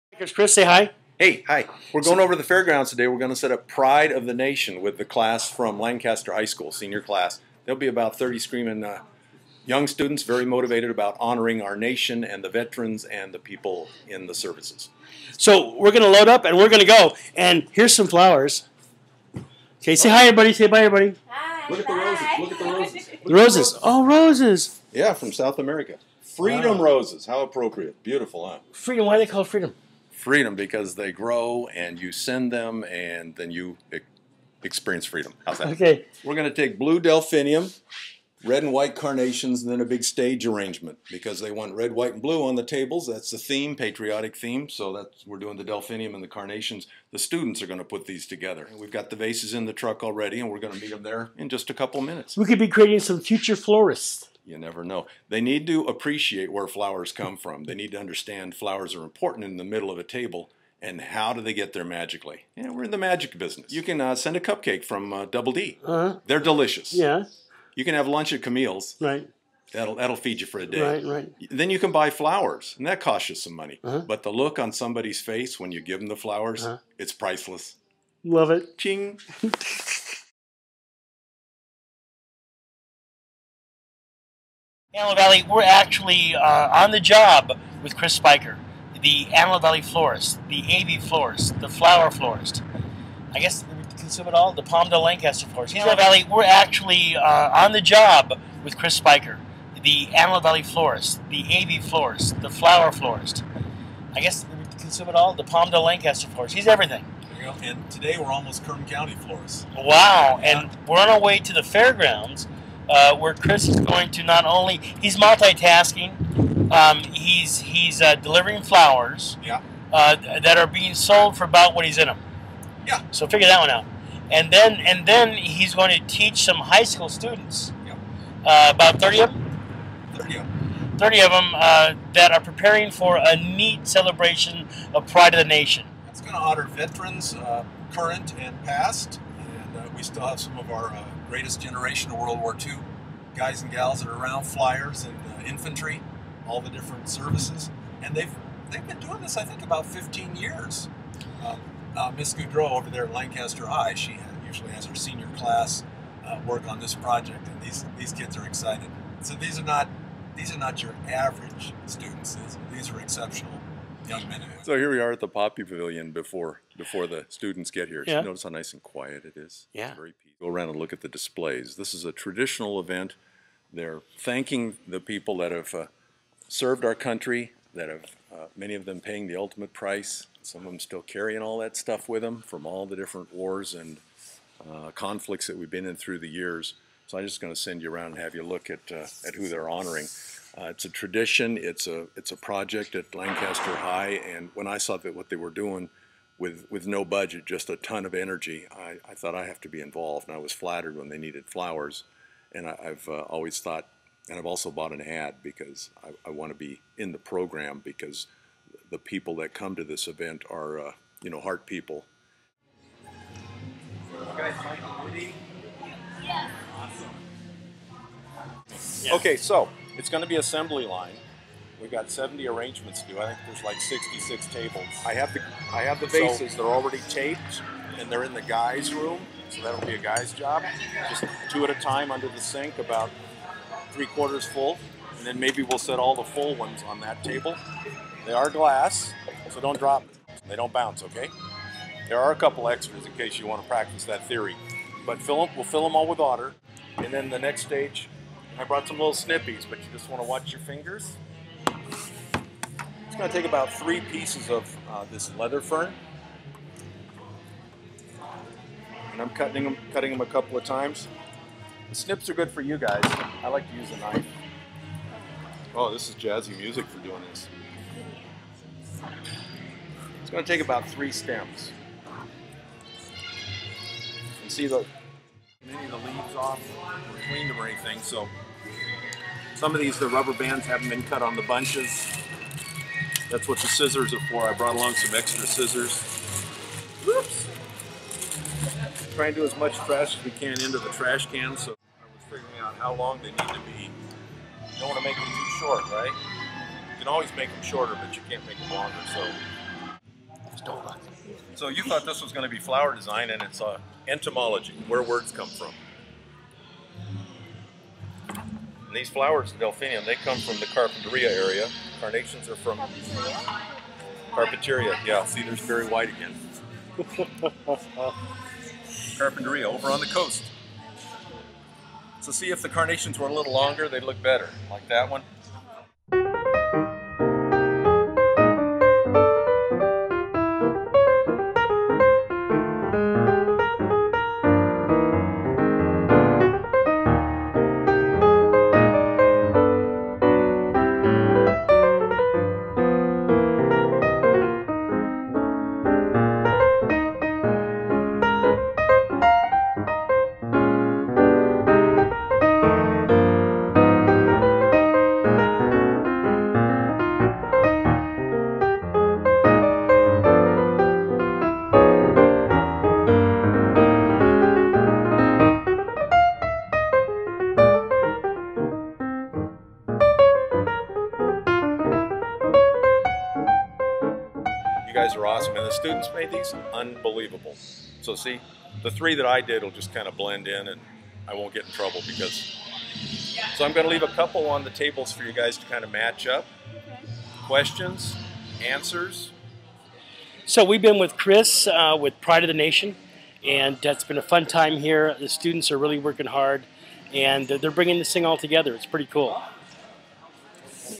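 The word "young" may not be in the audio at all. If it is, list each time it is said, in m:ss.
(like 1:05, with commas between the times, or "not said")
0:09, 2:44.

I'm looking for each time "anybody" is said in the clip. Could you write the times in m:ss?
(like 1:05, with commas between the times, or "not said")
not said.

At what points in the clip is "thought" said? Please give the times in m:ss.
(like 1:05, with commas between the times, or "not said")
3:19, 3:23, 5:01.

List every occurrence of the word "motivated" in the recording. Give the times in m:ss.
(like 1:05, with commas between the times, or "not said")
0:10.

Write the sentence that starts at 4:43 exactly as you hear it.
That's what the scissors are for.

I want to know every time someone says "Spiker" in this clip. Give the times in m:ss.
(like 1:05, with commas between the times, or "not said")
1:28, 1:38.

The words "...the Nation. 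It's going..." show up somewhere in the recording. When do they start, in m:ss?
2:15.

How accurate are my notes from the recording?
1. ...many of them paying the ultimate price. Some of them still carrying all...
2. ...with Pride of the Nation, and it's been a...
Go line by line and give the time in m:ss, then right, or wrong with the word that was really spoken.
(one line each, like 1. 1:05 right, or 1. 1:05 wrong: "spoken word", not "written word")
1. 2:58 right
2. 6:31 right.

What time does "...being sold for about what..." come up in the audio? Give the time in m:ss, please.
2:00.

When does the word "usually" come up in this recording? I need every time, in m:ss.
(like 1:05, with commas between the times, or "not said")
2:34.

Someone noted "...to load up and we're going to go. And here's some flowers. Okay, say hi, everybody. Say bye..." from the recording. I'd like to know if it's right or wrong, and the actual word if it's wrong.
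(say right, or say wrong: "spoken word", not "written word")
right.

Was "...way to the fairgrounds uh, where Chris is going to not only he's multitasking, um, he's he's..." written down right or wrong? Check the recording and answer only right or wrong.
right.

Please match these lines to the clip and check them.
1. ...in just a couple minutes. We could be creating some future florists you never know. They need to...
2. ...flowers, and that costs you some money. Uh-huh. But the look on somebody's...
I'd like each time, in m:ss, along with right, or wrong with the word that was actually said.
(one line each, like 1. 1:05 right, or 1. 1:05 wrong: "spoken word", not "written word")
1. 0:51 right
2. 1:12 right.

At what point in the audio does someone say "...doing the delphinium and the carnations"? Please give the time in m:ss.
0:45.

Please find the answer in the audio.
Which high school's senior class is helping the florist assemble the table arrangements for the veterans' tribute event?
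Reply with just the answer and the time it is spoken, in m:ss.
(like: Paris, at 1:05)
Lancaster High School, at 0:05.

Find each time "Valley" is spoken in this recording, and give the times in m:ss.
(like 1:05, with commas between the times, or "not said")
1:25, 1:29, 1:35, 1:40.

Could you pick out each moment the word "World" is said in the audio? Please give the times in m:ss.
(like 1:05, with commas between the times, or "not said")
2:22.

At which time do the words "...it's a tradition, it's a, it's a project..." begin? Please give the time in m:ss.
3:10.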